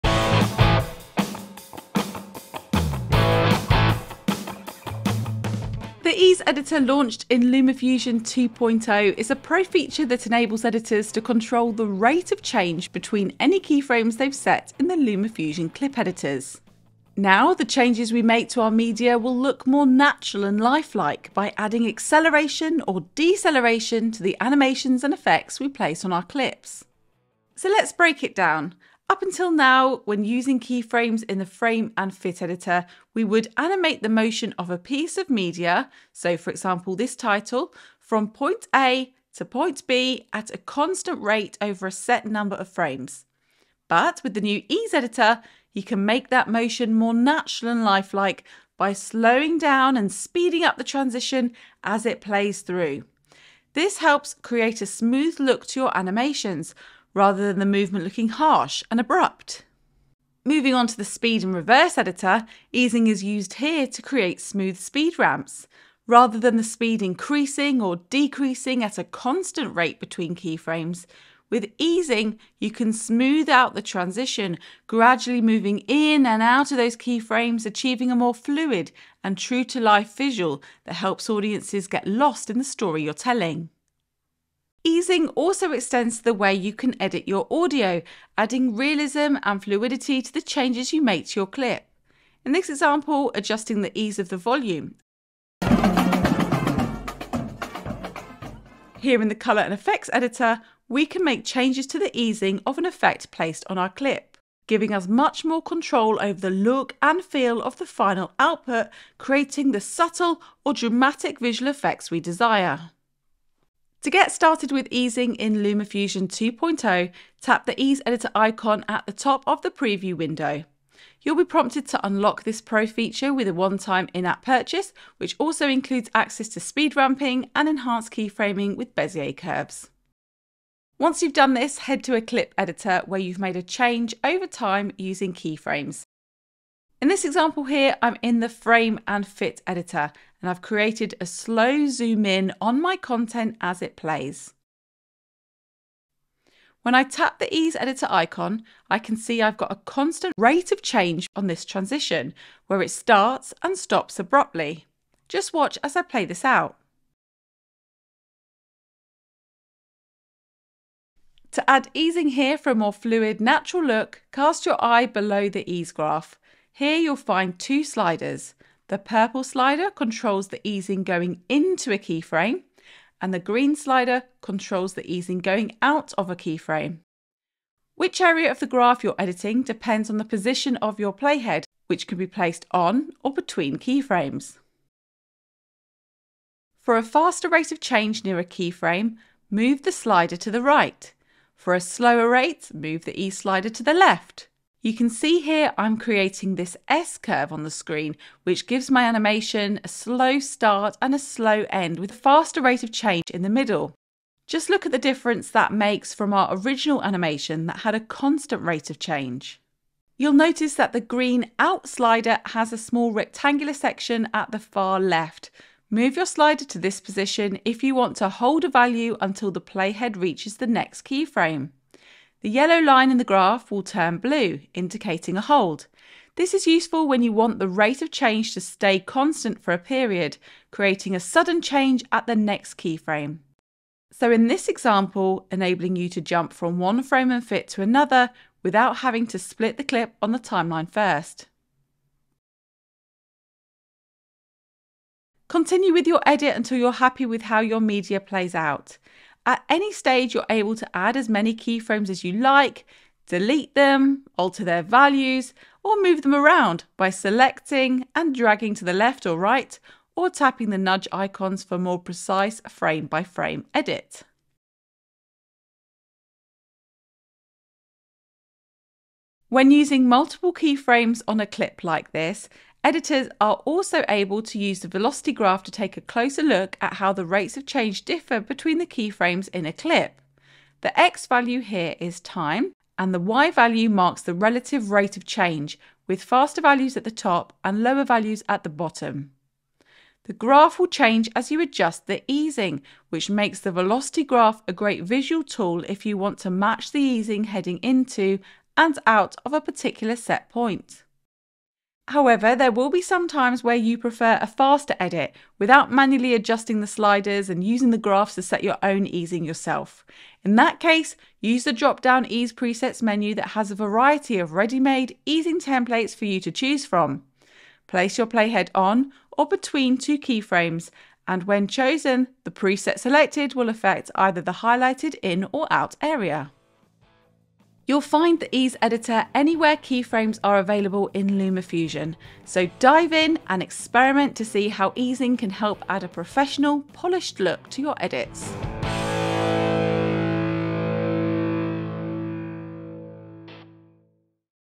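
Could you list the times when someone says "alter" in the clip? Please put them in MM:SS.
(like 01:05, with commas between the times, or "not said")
04:14.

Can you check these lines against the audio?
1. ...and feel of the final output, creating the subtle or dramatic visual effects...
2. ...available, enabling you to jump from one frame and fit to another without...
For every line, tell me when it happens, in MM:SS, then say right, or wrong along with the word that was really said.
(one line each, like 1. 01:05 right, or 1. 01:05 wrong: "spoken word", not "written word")
1. 01:47 right
2. 03:54 wrong: "example", not "available".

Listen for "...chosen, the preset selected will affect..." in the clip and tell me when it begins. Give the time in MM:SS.
05:21.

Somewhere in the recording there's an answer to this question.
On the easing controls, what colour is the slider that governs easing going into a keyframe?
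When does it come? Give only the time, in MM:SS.
02:48.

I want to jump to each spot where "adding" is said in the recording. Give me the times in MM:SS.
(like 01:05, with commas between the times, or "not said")
00:21, 01:28.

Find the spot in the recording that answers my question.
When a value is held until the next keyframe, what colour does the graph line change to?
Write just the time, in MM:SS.
03:44.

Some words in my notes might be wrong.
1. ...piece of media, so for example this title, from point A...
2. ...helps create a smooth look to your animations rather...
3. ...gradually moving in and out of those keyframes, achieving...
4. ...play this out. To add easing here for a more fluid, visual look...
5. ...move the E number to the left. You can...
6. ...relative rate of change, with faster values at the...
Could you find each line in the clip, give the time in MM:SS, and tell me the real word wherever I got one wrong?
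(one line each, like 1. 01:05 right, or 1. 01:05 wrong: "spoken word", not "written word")
1. 00:34 right
2. 00:53 right
3. 01:14 right
4. 02:36 wrong: "natural", not "visual"
5. 03:12 wrong: "slider", not "number"
6. 04:44 right.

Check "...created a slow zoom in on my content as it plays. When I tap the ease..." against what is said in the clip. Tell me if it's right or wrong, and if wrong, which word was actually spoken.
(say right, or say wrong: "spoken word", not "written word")
right.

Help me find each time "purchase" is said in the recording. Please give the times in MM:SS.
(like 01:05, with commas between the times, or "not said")
02:04.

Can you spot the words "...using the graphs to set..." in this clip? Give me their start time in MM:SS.
05:07.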